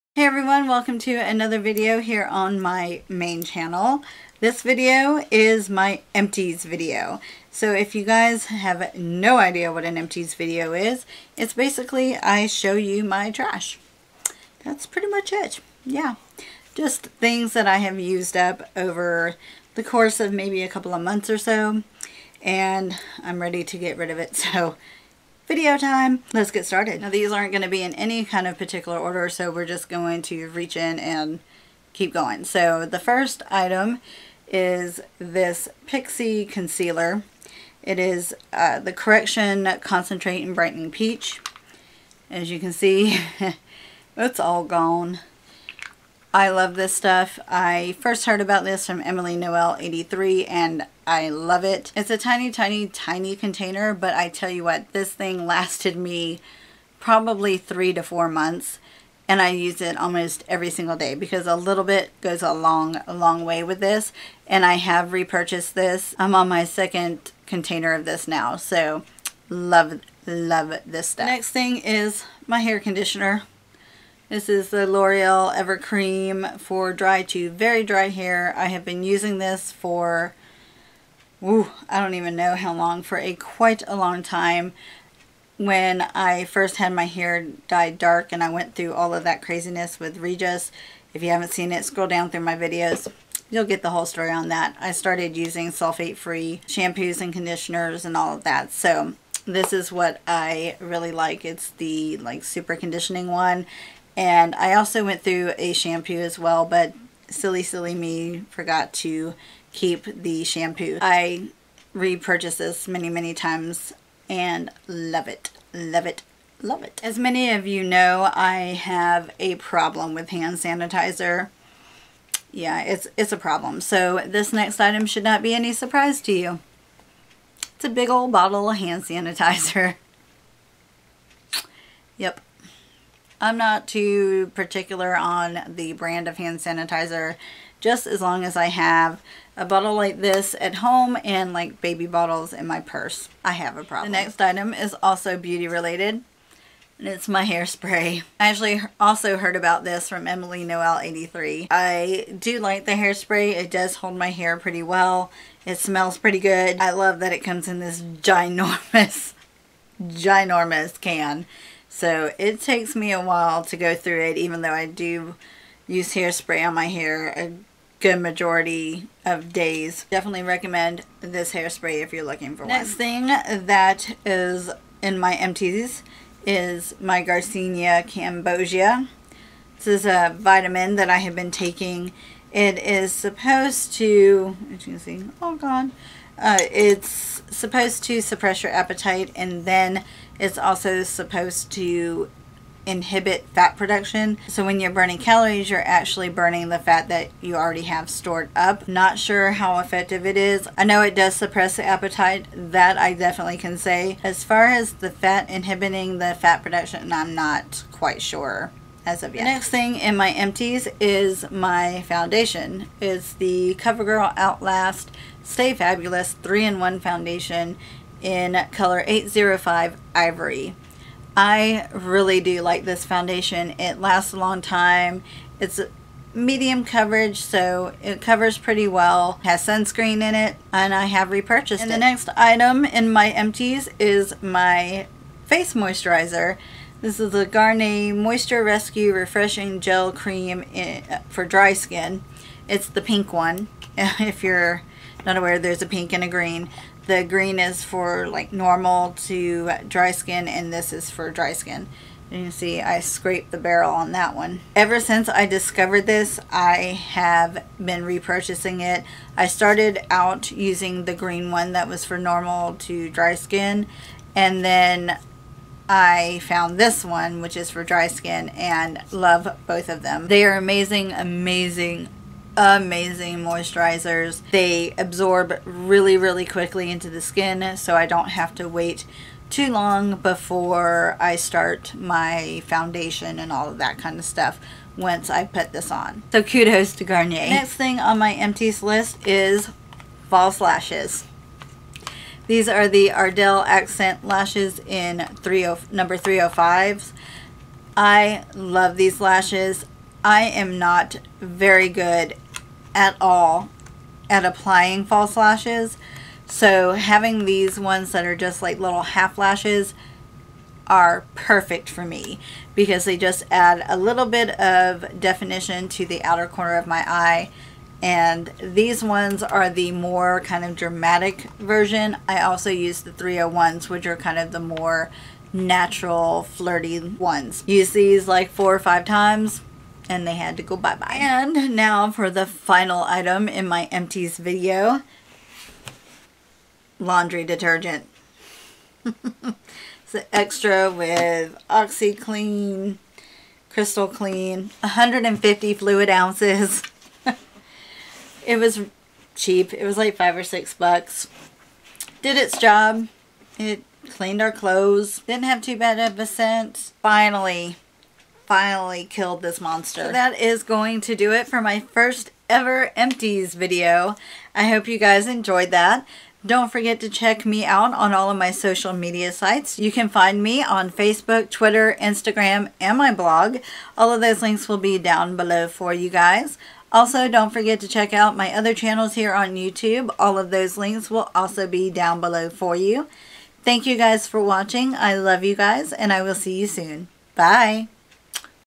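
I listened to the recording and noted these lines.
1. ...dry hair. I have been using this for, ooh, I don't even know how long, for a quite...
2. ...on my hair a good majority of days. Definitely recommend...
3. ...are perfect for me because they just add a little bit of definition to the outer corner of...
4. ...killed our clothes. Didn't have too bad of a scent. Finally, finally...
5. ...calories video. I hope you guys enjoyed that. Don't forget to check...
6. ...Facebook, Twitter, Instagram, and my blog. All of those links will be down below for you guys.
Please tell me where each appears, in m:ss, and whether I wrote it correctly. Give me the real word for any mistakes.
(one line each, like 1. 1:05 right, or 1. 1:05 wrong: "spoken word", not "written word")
1. 1:17 right
2. 2:46 right
3. 5:10 right
4. 5:54 wrong: "cleaned", not "killed"
5. 6:02 wrong: "empties", not "calories"
6. 6:10 right.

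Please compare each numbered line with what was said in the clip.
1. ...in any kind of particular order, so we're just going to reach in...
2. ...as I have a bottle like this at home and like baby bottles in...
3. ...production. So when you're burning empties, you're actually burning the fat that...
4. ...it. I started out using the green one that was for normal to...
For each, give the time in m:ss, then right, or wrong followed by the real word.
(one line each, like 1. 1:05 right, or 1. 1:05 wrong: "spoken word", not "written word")
1. 0:27 right
2. 2:18 right
3. 3:13 wrong: "calories", not "empties"
4. 4:18 right.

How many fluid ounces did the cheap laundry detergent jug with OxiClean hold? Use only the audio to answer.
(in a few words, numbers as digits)
150.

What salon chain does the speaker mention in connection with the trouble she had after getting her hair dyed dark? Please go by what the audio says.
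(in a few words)
Regis.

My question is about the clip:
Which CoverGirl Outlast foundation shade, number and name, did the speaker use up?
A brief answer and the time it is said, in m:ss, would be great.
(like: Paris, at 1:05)
805 Ivory, at 3:39.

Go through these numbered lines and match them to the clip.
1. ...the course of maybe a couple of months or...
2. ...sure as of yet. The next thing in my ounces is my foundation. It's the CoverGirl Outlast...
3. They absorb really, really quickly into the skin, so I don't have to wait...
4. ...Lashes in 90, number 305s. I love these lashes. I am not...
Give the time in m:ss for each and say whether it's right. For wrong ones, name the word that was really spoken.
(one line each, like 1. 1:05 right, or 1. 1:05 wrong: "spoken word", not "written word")
1. 0:19 right
2. 3:28 wrong: "empties", not "ounces"
3. 4:34 right
4. 4:54 wrong: "30", not "90".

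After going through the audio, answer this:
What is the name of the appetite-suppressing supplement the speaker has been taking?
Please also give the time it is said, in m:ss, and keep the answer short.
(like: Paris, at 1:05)
Garcinia Cambogia, at 2:57.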